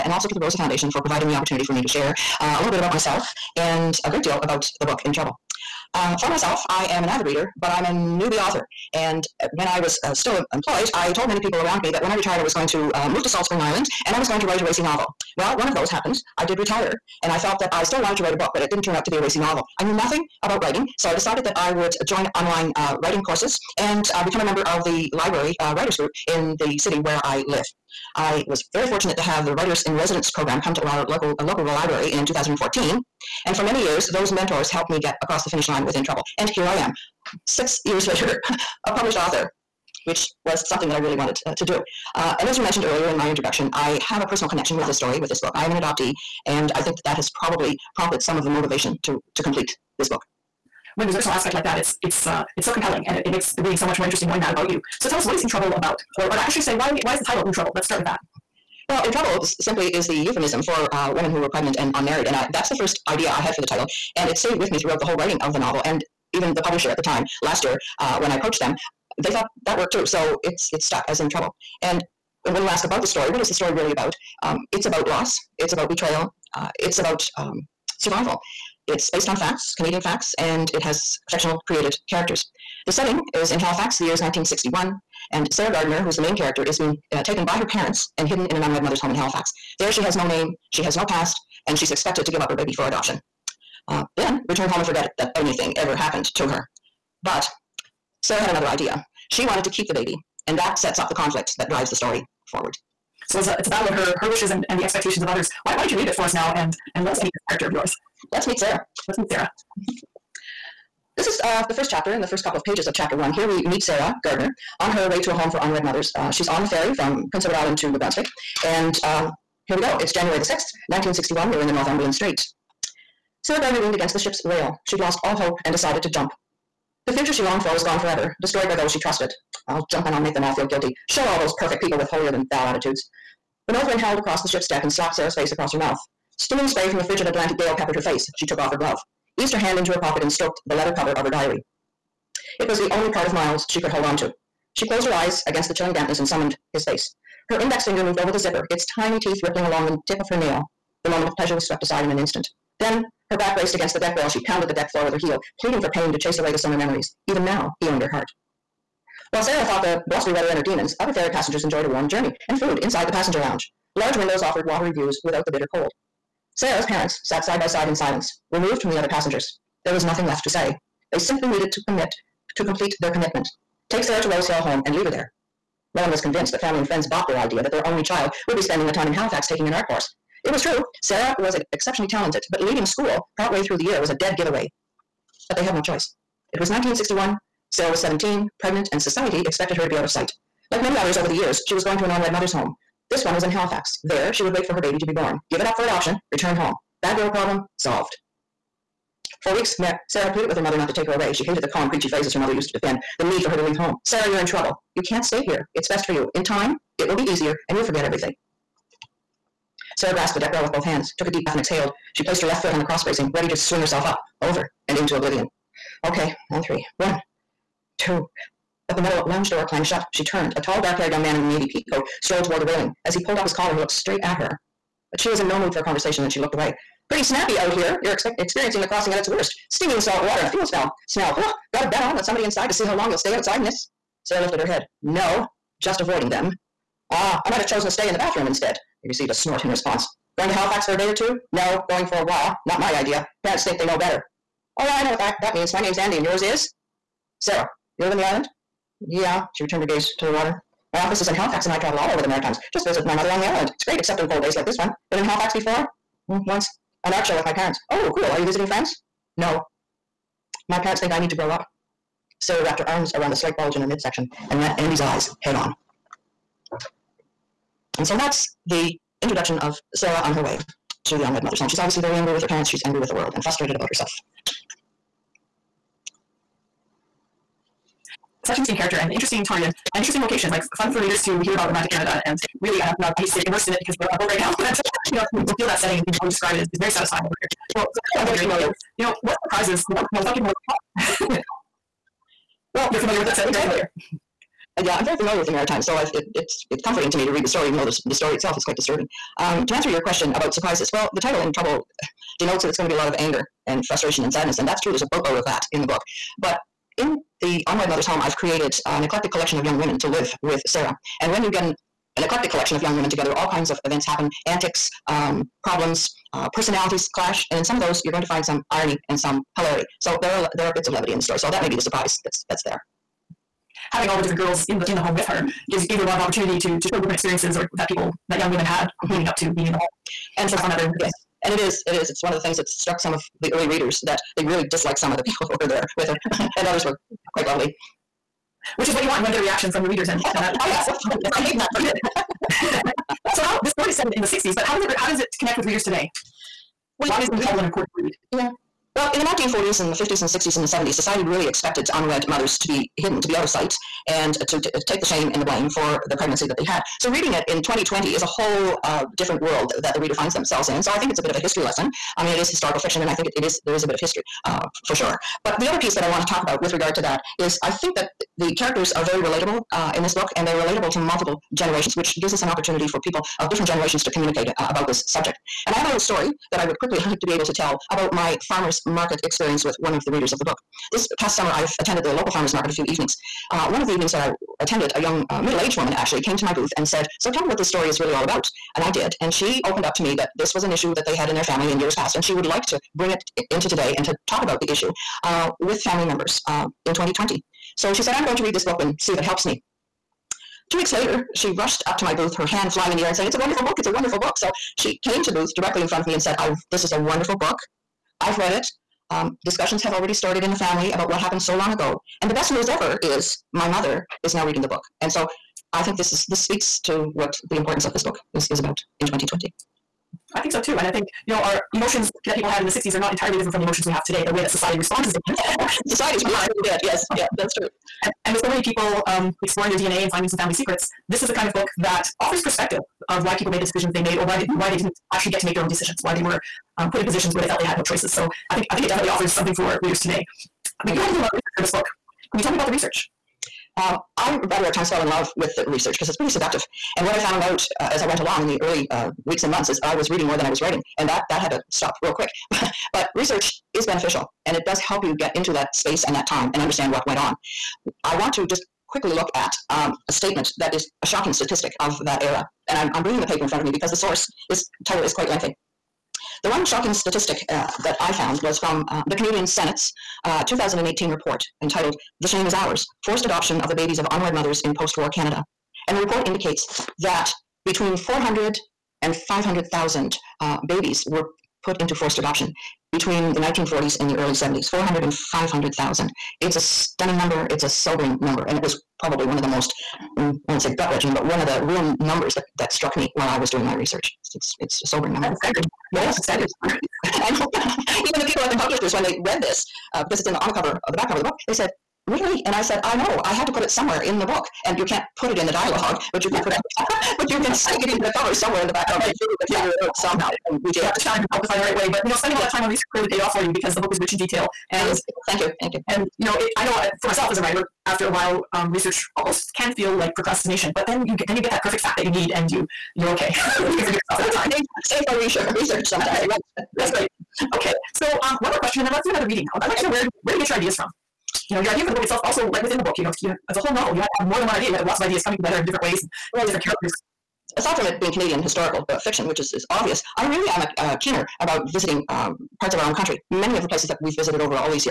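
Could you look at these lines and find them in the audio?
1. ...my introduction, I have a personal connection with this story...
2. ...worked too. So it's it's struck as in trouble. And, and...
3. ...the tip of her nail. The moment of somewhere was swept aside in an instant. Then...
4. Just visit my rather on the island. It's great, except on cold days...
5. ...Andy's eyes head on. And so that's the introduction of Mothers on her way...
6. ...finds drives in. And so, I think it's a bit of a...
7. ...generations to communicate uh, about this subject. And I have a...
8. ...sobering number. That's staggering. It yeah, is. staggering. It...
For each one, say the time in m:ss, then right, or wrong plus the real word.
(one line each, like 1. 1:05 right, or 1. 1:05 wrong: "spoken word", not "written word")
1. 0:43 right
2. 1:09 wrong: "stuck", not "struck"
3. 2:29 wrong: "pleasure", not "somewhere"
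4. 4:12 wrong: "mother", not "rather"
5. 4:24 wrong: "Sarah", not "Mothers"
6. 6:00 wrong: "themselves", not "drives"
7. 6:13 right
8. 8:14 right.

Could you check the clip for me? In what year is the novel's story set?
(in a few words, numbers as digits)
1961.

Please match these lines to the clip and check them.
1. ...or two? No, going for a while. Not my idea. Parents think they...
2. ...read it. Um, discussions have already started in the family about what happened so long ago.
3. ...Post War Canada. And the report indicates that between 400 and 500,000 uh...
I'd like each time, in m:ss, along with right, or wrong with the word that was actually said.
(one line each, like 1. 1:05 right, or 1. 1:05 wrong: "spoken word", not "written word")
1. 4:01 right
2. 6:48 right
3. 7:54 right.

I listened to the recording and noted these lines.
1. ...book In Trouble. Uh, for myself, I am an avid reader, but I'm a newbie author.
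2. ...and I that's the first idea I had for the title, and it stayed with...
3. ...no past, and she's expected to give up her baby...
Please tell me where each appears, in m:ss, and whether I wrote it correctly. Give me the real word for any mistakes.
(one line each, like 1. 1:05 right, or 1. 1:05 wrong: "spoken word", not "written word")
1. 0:04 right
2. 1:02 right
3. 1:30 right.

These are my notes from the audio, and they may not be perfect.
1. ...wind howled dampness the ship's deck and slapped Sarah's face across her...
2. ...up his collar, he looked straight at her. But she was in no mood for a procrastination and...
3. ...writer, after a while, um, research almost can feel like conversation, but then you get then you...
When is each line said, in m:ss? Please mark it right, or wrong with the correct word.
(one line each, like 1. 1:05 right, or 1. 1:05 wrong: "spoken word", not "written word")
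1. 2:13 wrong: "across", not "dampness"
2. 3:43 wrong: "conversation", not "procrastination"
3. 8:37 wrong: "procrastination", not "conversation".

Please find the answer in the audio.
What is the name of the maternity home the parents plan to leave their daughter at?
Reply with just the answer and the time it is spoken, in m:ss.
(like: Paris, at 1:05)
Rose Hill, at 2:54.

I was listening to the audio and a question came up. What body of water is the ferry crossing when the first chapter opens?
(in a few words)
Northumberland Strait.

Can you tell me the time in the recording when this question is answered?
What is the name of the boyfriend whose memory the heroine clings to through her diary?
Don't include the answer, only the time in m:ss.
2:23.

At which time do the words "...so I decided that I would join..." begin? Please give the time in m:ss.
0:20.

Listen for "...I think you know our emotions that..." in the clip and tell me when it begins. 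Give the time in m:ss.
7:00.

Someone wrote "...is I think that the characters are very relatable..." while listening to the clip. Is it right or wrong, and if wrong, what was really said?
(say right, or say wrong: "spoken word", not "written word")
right.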